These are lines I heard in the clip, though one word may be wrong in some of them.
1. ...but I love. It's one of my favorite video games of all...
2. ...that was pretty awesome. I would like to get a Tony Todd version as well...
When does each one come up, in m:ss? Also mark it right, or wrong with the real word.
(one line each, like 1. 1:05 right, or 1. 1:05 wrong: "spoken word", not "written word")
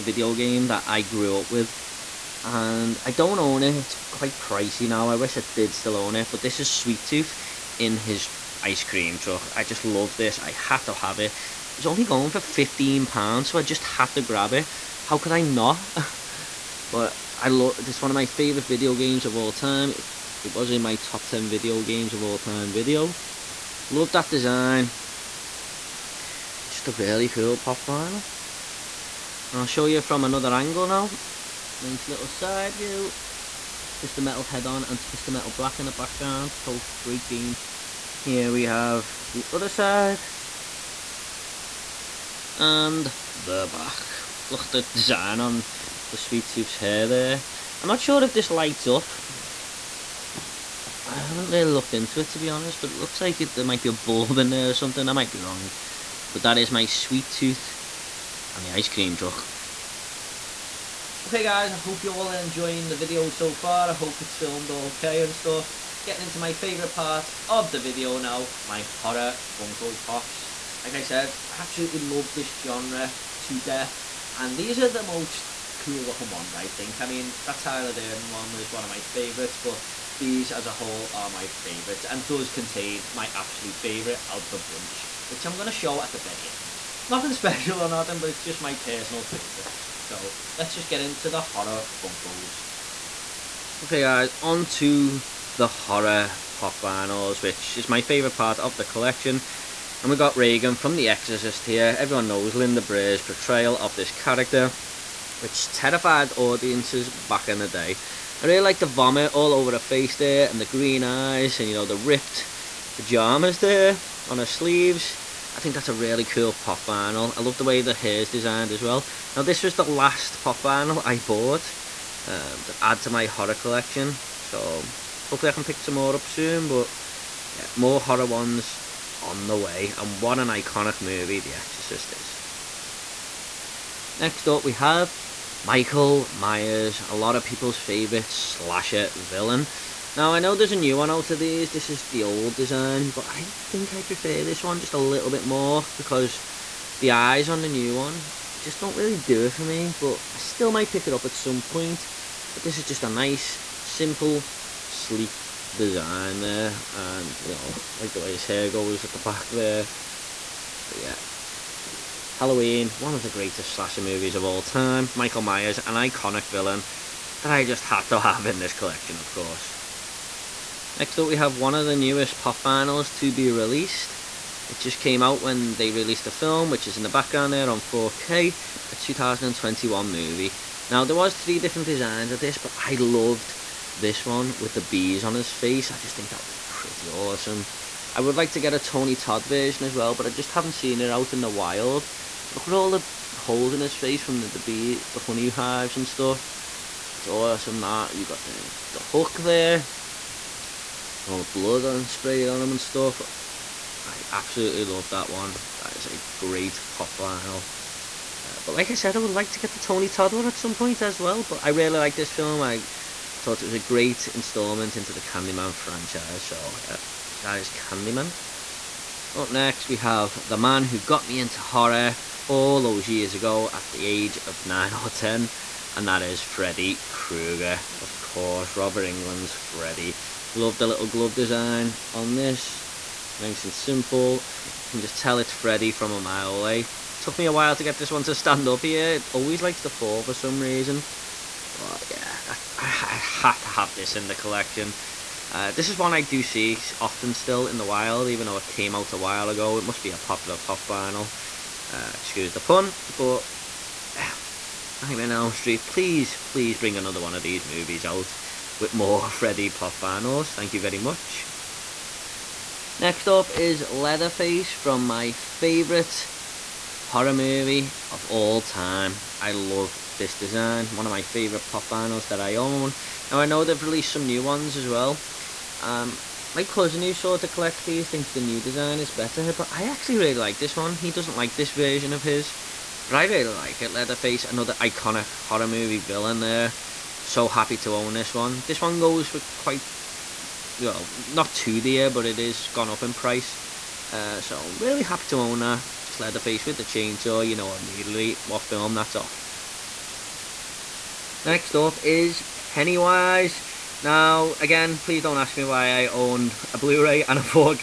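1. 0:16 right
2. 3:06 right.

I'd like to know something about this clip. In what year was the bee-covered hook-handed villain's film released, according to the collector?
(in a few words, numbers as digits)
2021.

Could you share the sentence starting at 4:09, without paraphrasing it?
It must be a popular pop vinyl.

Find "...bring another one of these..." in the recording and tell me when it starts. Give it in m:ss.
4:16.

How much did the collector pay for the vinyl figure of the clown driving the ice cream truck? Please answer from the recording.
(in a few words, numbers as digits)
15 pounds.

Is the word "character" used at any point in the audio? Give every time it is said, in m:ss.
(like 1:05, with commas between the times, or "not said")
1:44.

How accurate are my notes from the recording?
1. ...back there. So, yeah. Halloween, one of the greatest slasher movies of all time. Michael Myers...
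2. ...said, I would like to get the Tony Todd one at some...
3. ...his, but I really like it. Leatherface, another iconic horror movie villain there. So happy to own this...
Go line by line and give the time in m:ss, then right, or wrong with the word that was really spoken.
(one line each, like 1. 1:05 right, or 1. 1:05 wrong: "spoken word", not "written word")
1. 2:39 right
2. 3:28 right
3. 4:42 right.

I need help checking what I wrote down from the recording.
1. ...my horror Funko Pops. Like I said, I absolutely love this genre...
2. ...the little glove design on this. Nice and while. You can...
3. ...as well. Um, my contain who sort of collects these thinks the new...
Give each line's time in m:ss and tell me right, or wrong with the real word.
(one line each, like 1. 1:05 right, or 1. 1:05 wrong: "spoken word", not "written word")
1. 1:08 right
2. 3:50 wrong: "simple", not "while"
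3. 4:34 wrong: "cousin", not "contain".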